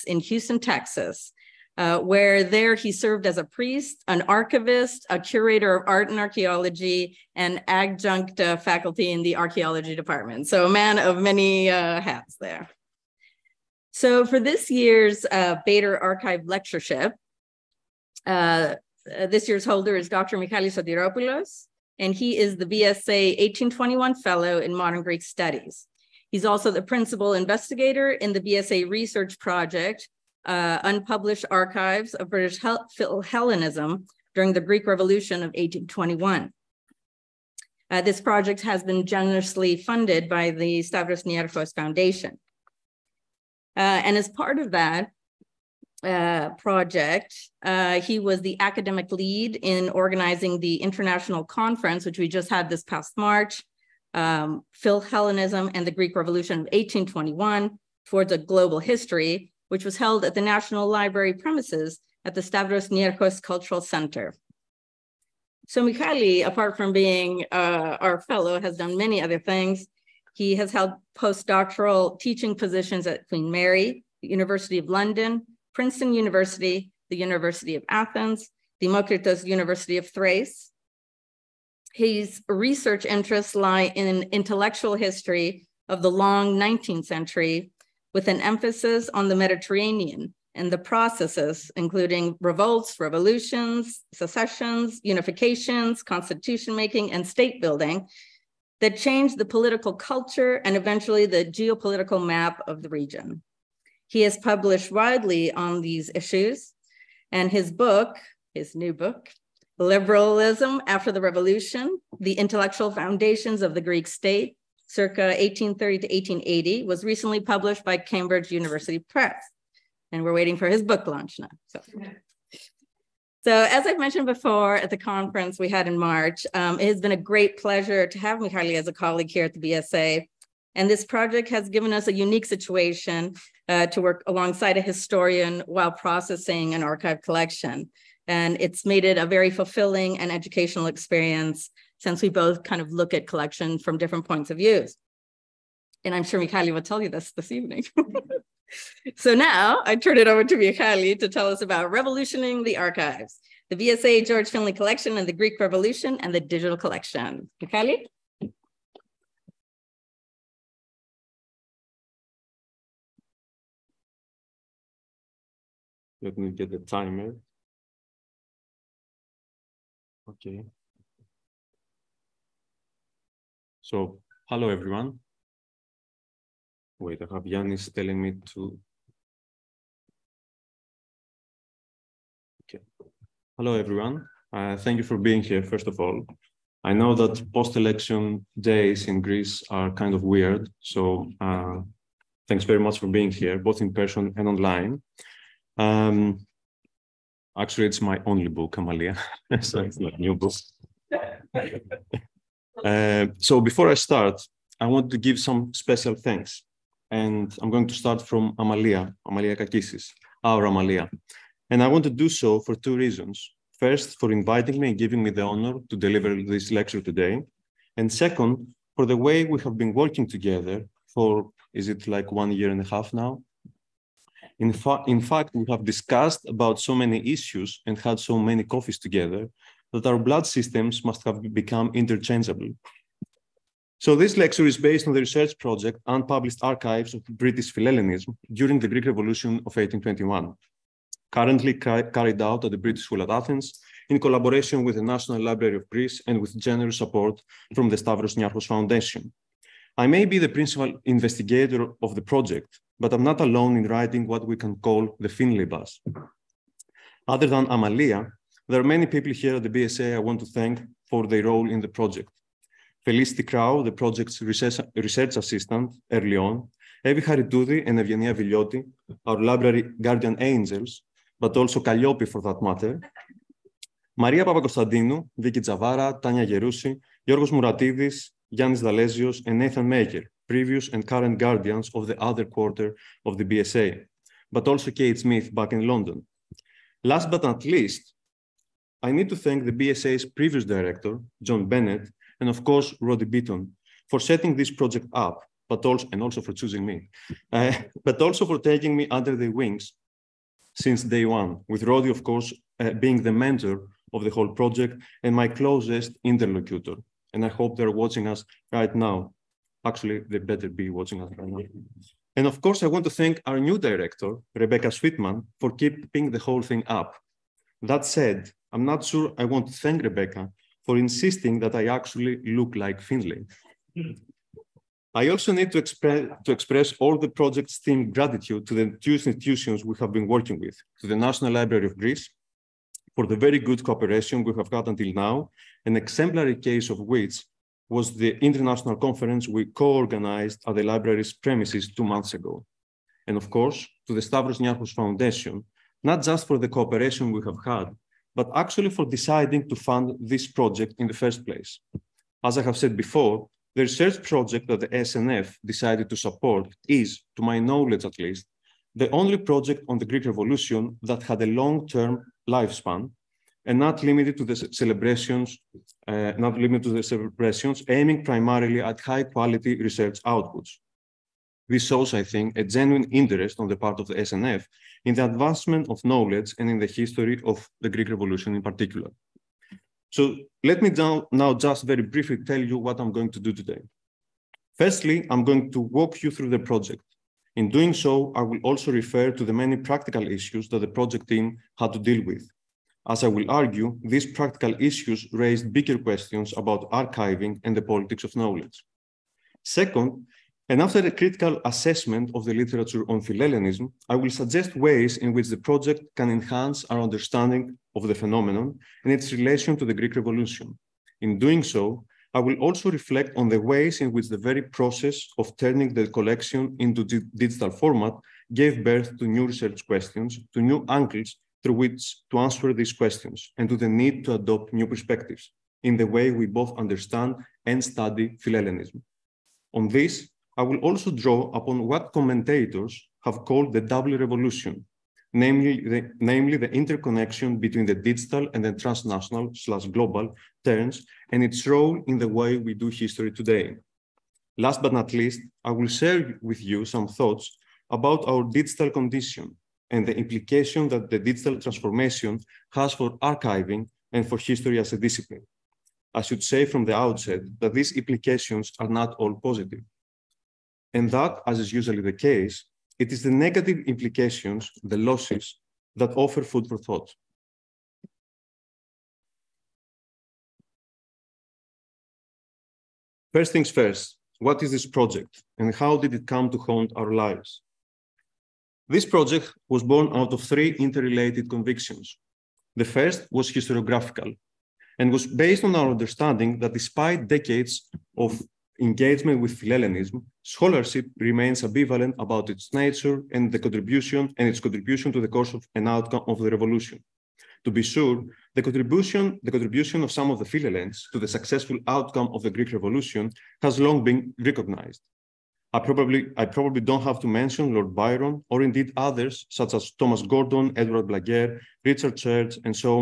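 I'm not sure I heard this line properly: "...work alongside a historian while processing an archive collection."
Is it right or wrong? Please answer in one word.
right.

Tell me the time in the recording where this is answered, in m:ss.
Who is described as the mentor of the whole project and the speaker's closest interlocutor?
4:52.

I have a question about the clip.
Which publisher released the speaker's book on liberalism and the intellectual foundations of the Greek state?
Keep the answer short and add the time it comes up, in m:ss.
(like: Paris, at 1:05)
Cambridge University Press, at 1:57.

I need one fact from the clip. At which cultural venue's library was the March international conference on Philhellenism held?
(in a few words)
Stavros Niarchos Cultural Center.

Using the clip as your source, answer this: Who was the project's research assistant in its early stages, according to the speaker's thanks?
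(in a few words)
Felicity Crow.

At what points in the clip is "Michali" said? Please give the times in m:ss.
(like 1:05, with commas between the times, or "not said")
0:20, 1:05, 2:08, 2:26, 2:30, 2:37.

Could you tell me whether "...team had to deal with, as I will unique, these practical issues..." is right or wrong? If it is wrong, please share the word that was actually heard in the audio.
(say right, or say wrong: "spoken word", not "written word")
wrong: "argue", not "unique".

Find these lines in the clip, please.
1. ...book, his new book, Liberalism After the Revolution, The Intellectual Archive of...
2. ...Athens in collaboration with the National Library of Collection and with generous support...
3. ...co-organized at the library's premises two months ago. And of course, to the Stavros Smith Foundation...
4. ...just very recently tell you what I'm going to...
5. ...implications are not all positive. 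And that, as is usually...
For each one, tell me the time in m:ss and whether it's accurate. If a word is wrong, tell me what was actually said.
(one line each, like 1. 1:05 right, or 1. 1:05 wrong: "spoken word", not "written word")
1. 1:47 wrong: "Foundations", not "Archive"
2. 4:03 wrong: "Greece", not "Collection"
3. 5:39 wrong: "Niarchos", not "Smith"
4. 6:21 wrong: "briefly", not "recently"
5. 7:37 right.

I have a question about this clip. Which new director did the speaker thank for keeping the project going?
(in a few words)
Rebecca Sweetman.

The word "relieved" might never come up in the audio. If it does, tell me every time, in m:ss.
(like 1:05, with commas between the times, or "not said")
not said.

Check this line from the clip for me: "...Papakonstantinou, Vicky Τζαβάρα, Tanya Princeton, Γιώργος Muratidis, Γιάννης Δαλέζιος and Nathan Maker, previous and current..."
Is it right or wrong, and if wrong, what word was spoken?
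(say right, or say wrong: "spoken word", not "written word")
wrong: "Γερούση", not "Princeton".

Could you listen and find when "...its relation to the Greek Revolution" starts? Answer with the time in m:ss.
6:49.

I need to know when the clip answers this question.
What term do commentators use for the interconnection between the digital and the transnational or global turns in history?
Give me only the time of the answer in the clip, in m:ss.
7:13.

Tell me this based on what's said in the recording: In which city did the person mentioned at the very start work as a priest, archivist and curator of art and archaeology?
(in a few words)
Houston, Texas.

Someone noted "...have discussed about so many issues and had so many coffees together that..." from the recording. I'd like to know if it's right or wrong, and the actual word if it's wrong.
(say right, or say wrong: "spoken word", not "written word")
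right.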